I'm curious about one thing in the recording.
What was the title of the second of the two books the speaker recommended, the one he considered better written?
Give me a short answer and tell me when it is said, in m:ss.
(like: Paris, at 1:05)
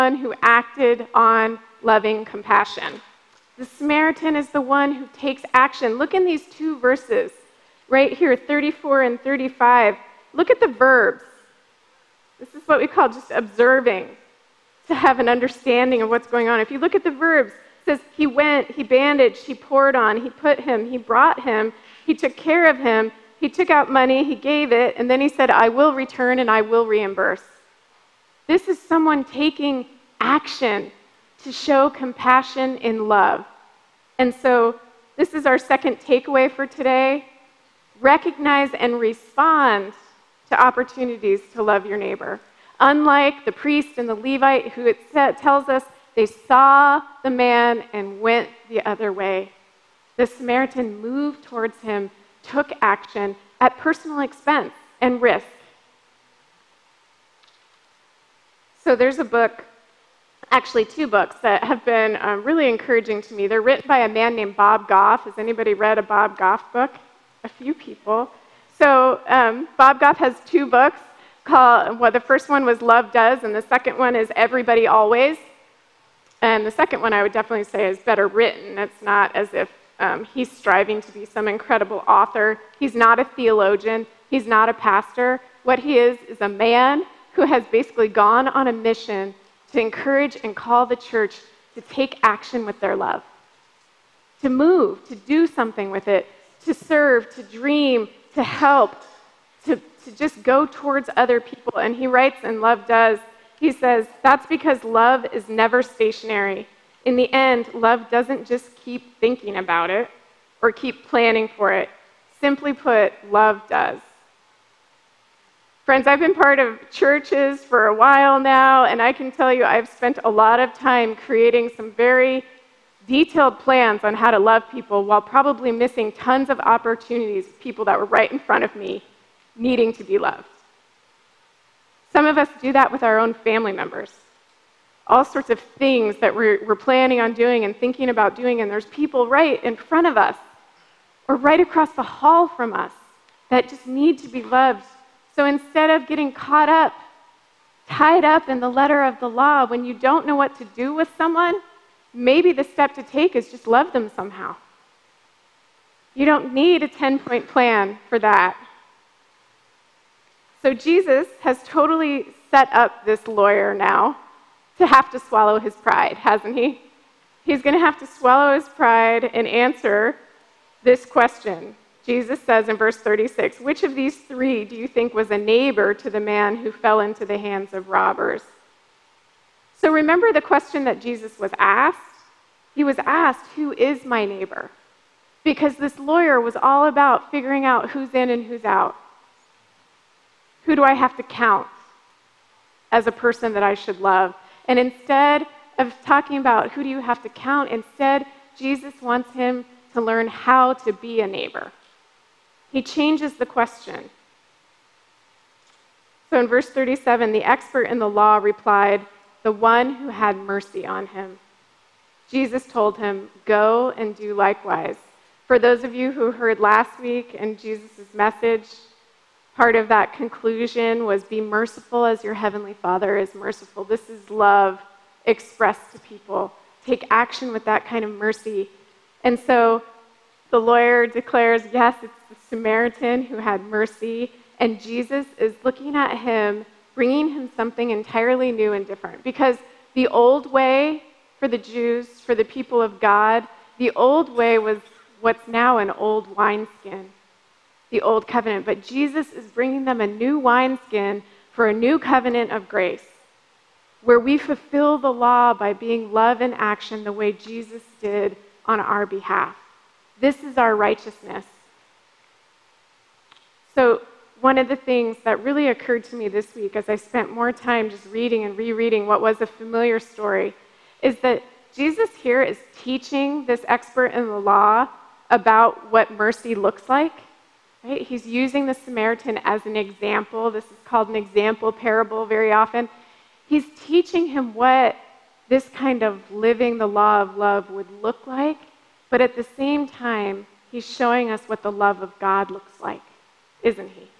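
Everybody Always, at 1:14.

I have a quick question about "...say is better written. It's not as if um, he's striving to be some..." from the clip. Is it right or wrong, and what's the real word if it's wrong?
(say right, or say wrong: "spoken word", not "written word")
right.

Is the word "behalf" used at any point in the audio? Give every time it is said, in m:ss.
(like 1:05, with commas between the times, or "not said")
4:19.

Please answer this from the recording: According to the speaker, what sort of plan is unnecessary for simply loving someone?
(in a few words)
A 10 point plan.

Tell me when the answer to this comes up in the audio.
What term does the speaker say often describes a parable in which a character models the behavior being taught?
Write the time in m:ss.
4:41.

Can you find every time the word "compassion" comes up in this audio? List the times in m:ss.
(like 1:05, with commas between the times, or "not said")
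0:02, 0:31.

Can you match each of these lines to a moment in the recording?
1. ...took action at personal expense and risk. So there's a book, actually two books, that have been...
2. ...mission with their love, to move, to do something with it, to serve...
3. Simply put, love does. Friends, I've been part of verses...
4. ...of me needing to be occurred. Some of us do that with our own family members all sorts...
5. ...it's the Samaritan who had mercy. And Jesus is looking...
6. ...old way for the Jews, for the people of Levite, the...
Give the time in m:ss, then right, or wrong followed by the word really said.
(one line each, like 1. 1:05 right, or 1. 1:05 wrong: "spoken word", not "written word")
1. 0:52 right
2. 1:32 wrong: "action", not "mission"
3. 1:52 wrong: "churches", not "verses"
4. 2:08 wrong: "loved", not "occurred"
5. 3:52 right
6. 4:00 wrong: "God", not "Levite".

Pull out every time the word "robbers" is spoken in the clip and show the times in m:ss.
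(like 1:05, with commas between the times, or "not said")
2:57.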